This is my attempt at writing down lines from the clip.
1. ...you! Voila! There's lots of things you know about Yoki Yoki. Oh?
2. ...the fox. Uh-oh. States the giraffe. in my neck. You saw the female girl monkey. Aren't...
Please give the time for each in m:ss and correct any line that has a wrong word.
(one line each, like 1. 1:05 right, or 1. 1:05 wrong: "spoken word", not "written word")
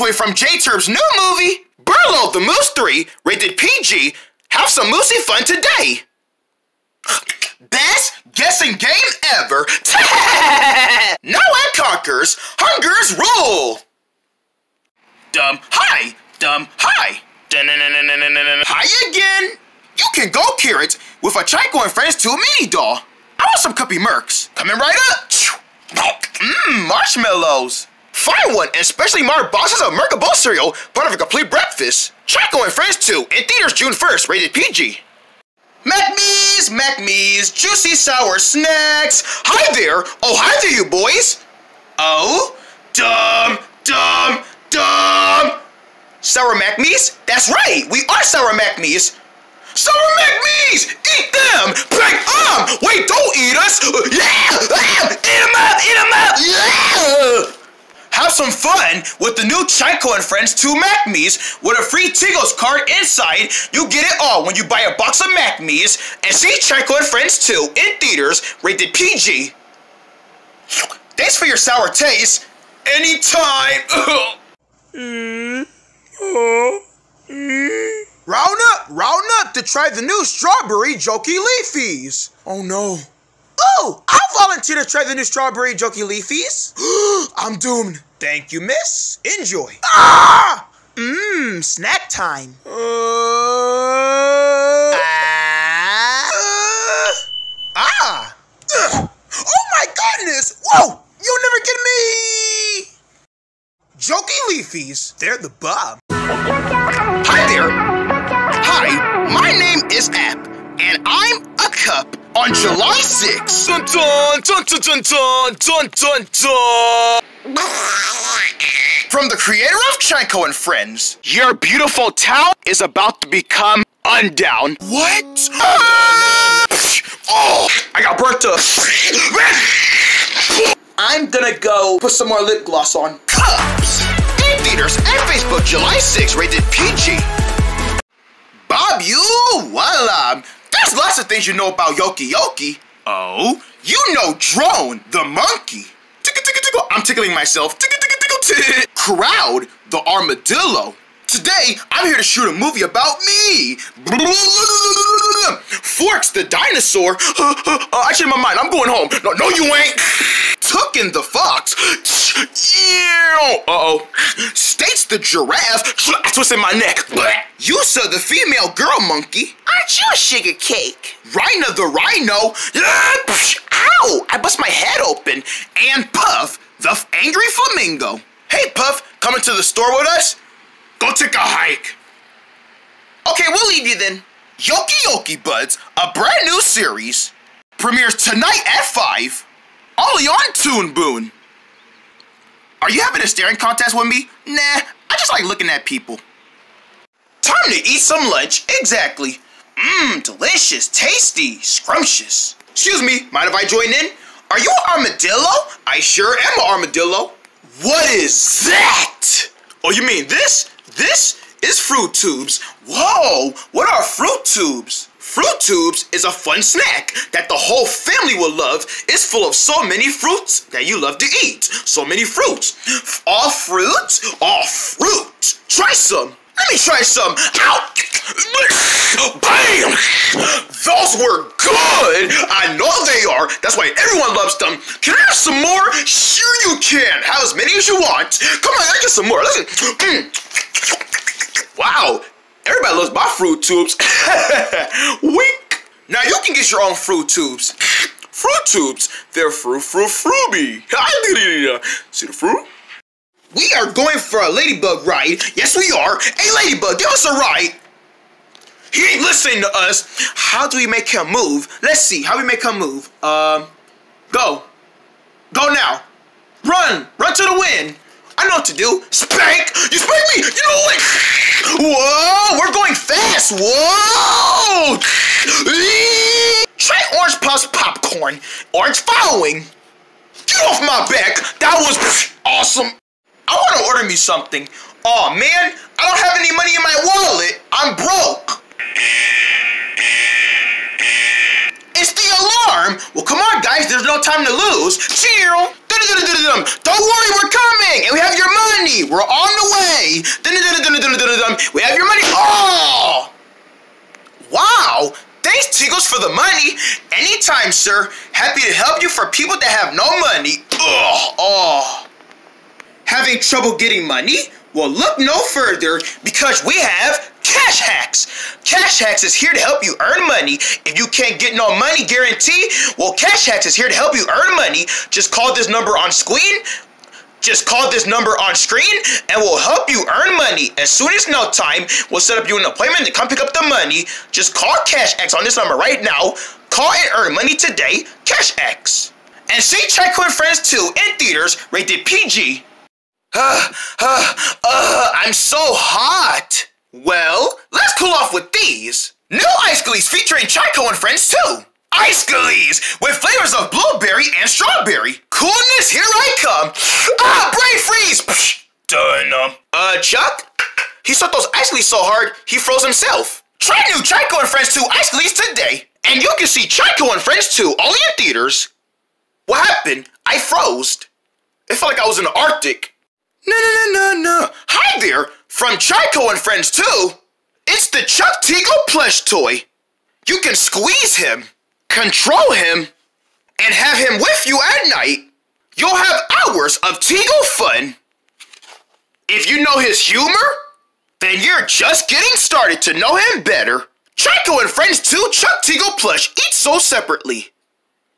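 1. 2:19 right
2. 2:41 right.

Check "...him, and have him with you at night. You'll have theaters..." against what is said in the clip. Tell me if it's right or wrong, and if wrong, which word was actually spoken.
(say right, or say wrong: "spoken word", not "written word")
wrong: "hours", not "theaters".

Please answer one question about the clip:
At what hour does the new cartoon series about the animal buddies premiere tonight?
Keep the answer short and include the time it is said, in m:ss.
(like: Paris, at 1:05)
5, at 3:08.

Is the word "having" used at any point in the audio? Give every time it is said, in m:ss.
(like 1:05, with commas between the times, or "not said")
3:13, 5:13.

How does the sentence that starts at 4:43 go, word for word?
I want to order me something.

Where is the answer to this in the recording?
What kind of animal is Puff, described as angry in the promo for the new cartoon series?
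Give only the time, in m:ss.
2:57.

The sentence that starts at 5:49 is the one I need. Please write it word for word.
New Ice Glees featuring Chico and friends too!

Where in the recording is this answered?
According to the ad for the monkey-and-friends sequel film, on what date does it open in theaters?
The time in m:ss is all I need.
0:33.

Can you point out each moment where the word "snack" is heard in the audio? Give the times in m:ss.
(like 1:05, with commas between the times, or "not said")
0:38, 1:31, 3:36.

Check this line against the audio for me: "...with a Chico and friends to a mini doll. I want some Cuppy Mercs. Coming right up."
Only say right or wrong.
right.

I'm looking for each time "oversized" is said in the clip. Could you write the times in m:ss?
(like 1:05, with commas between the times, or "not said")
not said.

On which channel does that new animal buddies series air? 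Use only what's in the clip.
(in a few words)
Toon Boon.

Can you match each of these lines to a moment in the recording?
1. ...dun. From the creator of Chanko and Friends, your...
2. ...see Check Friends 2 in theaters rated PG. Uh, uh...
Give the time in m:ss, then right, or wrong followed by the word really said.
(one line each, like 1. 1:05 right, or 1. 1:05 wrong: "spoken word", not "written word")
1. 1:57 right
2. 5:39 right.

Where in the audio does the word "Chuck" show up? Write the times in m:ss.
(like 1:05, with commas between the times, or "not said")
5:59, 6:18, 6:35.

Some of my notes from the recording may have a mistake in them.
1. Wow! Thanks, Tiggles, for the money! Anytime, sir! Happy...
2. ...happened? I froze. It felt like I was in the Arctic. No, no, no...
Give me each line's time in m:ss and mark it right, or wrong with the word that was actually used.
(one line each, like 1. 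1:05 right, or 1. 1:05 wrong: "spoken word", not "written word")
1. 5:04 right
2. 6:09 right.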